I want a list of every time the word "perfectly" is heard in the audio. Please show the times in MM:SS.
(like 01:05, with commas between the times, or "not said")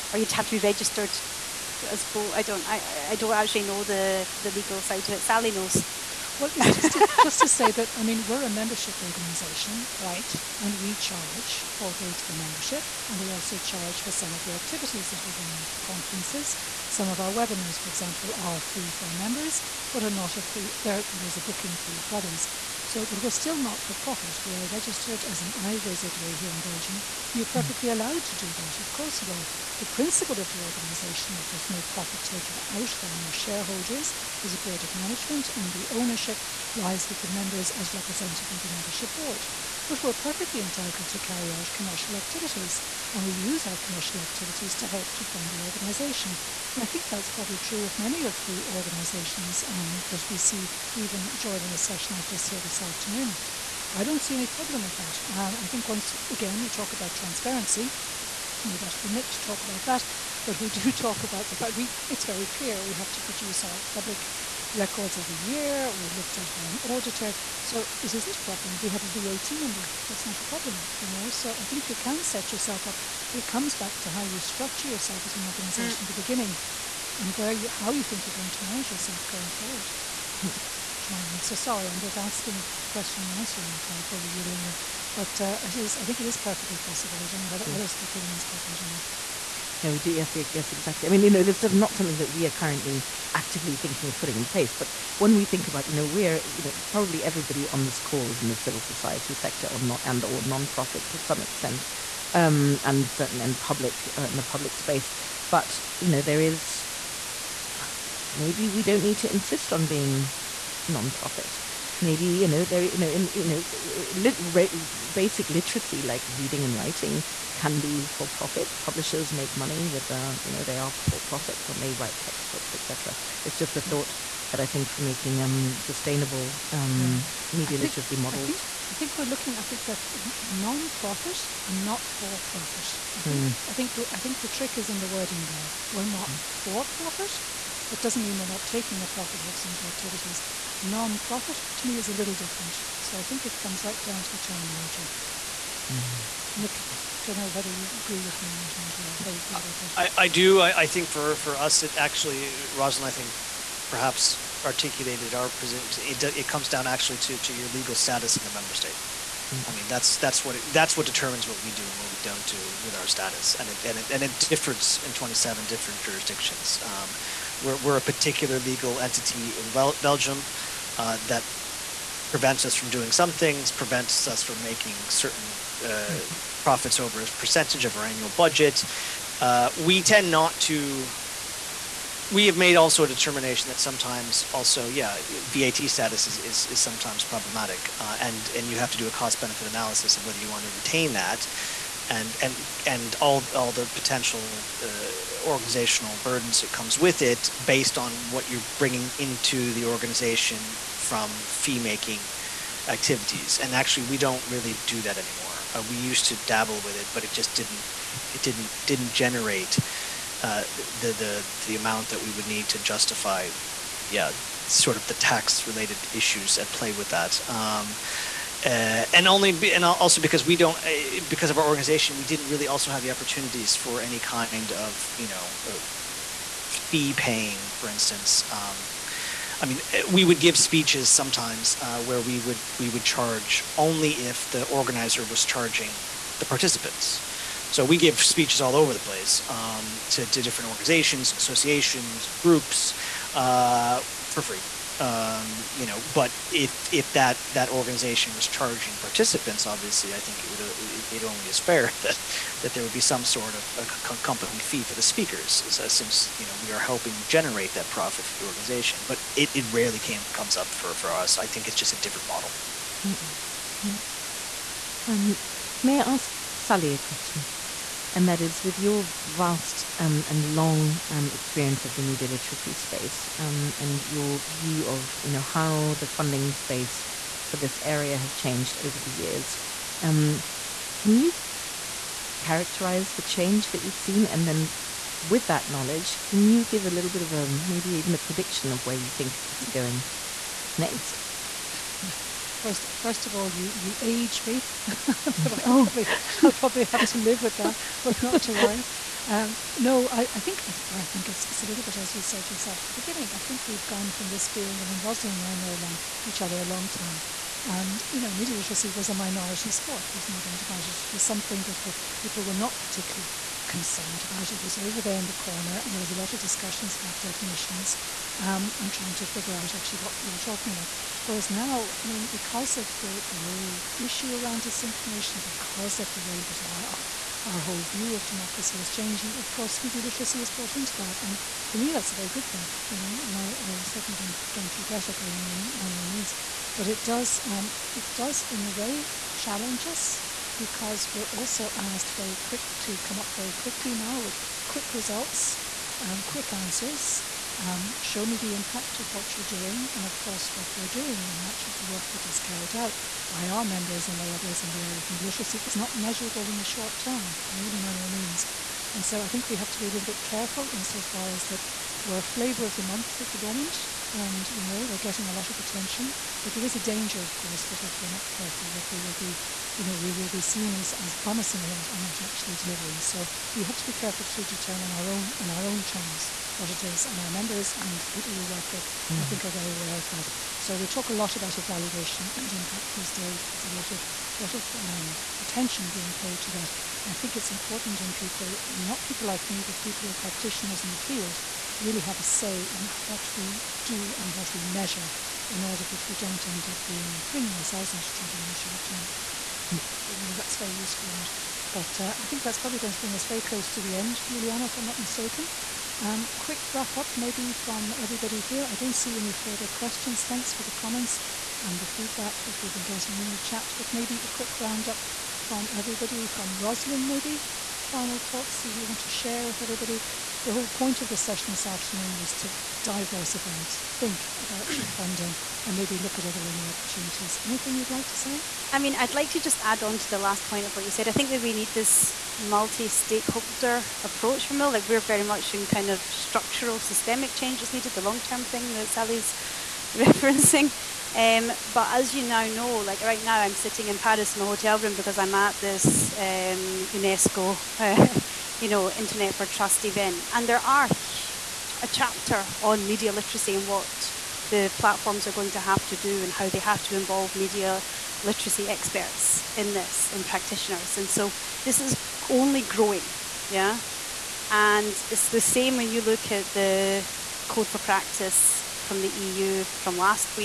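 00:27, 00:40, 01:26.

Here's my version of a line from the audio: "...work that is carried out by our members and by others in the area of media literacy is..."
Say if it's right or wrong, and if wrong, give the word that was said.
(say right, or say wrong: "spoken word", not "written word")
right.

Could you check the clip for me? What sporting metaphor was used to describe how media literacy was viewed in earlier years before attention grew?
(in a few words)
A minority sport.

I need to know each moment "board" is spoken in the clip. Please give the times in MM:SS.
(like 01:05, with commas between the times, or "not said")
00:34, 00:39.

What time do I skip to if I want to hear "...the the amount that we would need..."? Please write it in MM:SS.
03:31.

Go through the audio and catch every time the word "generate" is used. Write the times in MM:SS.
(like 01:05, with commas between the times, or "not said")
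03:29, 04:17.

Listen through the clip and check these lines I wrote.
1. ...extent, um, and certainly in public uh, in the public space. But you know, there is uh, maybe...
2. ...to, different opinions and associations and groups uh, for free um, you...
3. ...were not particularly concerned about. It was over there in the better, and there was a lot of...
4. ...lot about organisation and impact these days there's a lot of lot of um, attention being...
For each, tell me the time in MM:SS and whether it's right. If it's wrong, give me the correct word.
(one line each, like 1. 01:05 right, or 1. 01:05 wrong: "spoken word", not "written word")
1. 01:41 right
2. 04:00 wrong: "organizations", not "opinions"
3. 05:12 wrong: "corner", not "better"
4. 06:21 wrong: "evaluation", not "organisation".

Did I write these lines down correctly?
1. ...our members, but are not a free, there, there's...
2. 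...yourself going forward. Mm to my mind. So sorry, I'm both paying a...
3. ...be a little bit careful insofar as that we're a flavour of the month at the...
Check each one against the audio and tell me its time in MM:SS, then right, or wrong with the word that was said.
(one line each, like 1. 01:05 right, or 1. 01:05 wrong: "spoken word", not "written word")
1. 00:19 right
2. 01:18 wrong: "asking", not "paying"
3. 05:59 right.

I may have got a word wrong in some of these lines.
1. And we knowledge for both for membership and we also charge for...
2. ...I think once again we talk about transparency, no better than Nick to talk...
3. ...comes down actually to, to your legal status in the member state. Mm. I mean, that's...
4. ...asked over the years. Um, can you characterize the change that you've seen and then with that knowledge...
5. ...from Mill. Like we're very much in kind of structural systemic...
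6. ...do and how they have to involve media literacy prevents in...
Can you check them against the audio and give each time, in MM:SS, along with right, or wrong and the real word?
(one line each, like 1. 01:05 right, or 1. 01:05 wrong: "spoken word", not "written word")
1. 00:10 wrong: "charge", not "knowledge"
2. 00:55 right
3. 02:36 right
4. 04:38 wrong: "changed", not "asked"
5. 07:14 right
6. 07:35 wrong: "experts", not "prevents".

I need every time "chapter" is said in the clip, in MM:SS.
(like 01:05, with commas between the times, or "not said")
07:31.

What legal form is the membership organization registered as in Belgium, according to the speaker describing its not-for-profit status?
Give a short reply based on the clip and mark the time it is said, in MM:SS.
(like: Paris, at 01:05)
IVZW, at 00:25.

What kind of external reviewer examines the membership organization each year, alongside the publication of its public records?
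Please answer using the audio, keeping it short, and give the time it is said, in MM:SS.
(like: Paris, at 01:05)
An auditor, at 01:06.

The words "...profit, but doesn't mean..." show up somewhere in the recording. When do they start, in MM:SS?
02:16.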